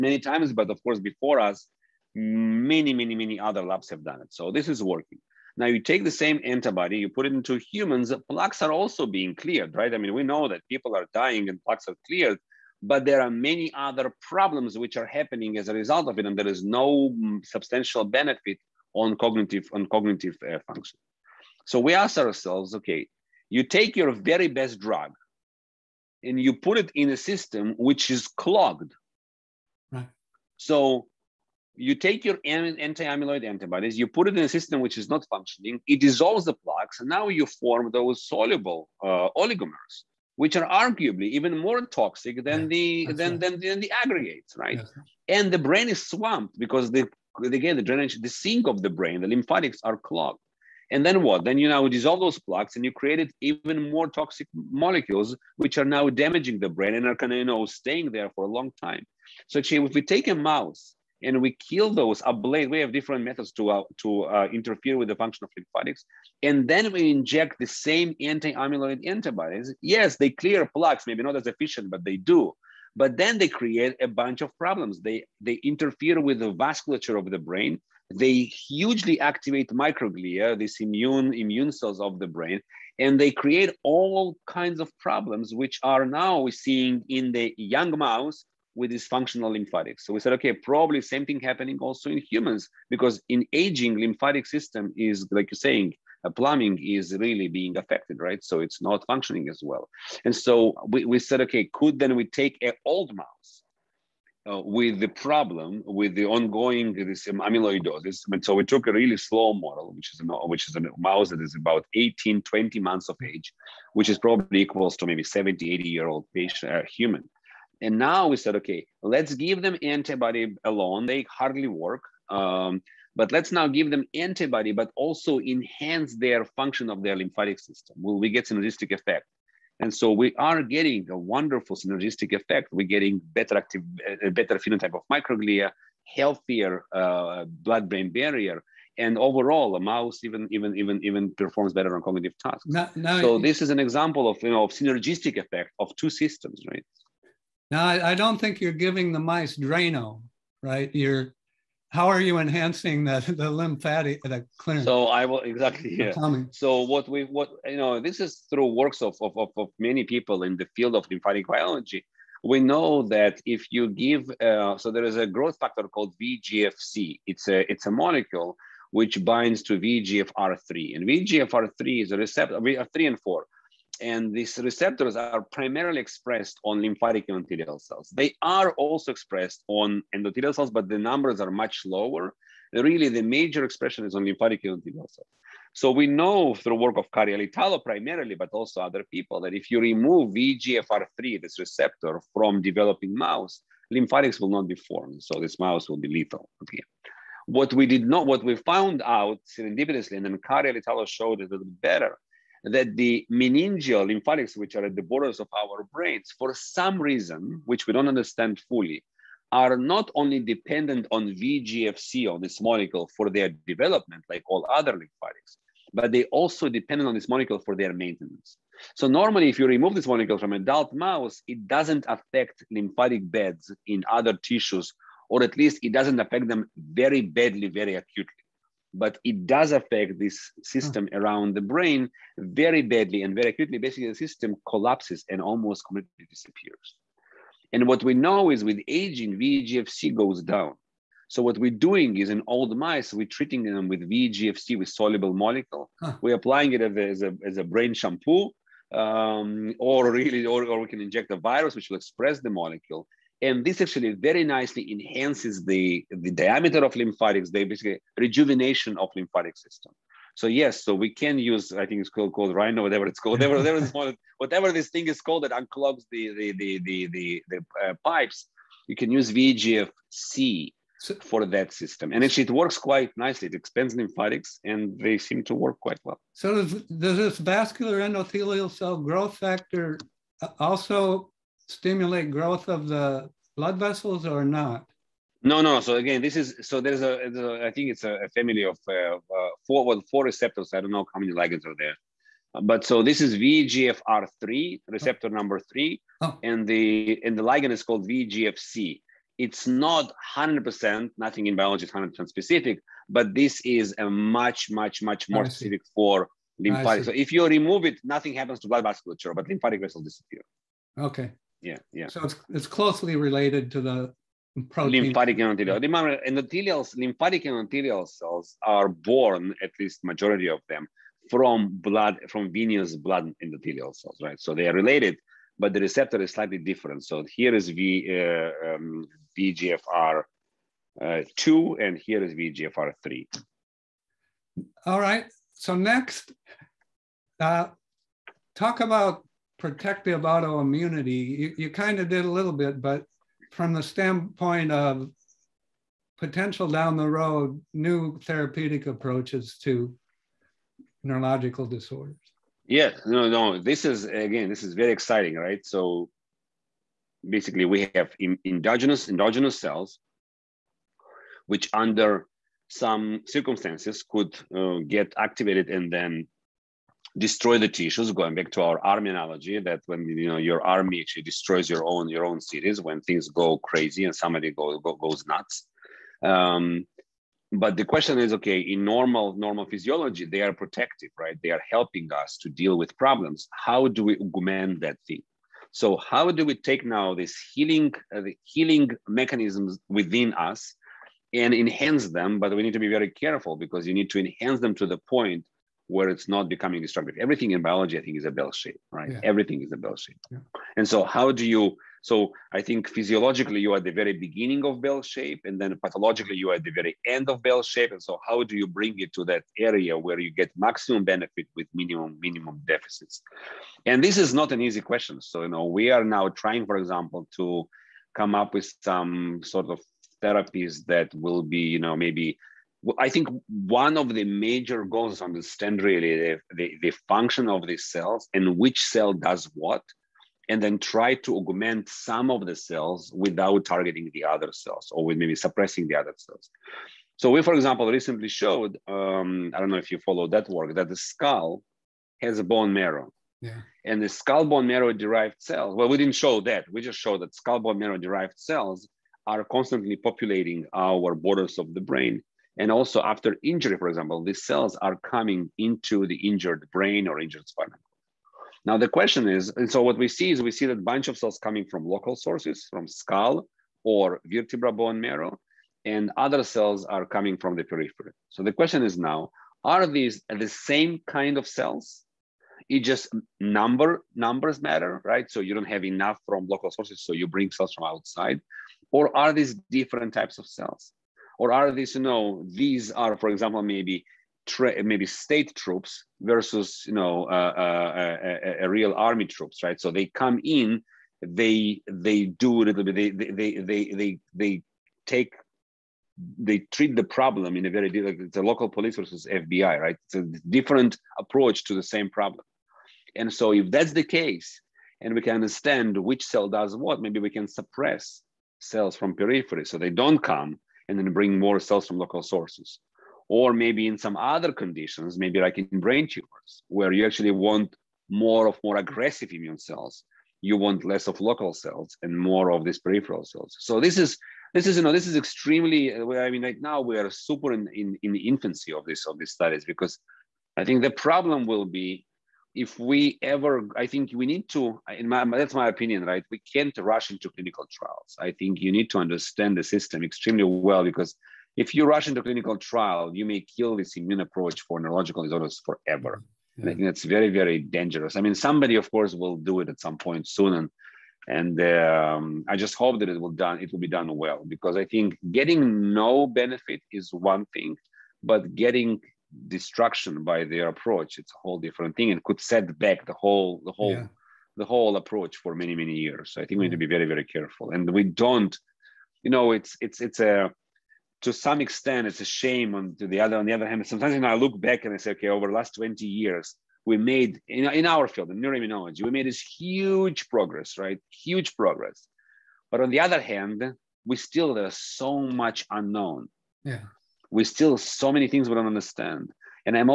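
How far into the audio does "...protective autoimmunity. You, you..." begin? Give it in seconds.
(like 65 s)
339 s.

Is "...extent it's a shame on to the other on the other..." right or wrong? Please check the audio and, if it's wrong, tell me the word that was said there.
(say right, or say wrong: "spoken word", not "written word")
right.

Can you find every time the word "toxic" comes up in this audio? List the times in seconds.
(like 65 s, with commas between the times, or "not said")
41 s, 54 s.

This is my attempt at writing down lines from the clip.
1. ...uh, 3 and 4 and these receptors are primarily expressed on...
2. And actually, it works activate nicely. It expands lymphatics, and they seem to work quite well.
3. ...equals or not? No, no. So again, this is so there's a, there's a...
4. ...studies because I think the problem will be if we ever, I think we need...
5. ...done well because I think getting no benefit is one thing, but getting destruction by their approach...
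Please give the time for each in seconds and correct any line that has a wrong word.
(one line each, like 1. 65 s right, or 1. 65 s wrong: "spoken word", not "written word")
1. 172 s right
2. 272 s wrong: "quite", not "activate"
3. 283 s wrong: "vessels", not "equals"
4. 529 s right
5. 553 s right.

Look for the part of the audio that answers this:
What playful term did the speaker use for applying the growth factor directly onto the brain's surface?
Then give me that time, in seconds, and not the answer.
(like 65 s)
247 s.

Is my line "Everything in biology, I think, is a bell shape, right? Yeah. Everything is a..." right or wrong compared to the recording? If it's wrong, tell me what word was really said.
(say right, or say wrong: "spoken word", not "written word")
right.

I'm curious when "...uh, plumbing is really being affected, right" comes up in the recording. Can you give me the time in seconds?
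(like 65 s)
96 s.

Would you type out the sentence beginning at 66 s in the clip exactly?
And then we inject the same anti-amyloid antibodies.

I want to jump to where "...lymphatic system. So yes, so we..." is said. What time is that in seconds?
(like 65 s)
259 s.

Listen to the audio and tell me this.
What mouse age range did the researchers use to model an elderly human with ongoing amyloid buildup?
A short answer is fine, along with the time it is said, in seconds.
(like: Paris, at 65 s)
18 to 20 months, at 111 s.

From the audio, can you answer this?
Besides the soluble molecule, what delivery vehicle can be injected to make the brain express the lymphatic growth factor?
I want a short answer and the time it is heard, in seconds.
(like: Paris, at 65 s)
a virus, at 251 s.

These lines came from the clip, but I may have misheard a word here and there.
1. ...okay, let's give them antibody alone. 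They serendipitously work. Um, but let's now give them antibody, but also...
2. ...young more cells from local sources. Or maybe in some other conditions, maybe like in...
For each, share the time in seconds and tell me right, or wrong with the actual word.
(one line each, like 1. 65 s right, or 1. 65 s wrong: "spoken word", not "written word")
1. 118 s wrong: "hardly", not "serendipitously"
2. 511 s wrong: "bring", not "young".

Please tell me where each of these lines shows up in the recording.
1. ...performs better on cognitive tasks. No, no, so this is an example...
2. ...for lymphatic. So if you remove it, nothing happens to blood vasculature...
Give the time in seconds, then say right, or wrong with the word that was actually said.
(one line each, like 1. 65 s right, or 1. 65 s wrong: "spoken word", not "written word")
1. 141 s right
2. 305 s right.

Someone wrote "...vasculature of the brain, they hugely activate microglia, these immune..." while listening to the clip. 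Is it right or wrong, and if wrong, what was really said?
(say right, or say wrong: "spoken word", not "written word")
right.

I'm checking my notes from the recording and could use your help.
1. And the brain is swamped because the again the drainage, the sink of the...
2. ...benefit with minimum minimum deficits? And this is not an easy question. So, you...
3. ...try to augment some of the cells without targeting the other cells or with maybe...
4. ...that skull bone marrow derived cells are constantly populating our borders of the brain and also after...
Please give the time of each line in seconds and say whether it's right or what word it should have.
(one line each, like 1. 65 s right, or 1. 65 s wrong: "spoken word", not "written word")
1. 45 s right
2. 411 s right
3. 430 s right
4. 447 s right.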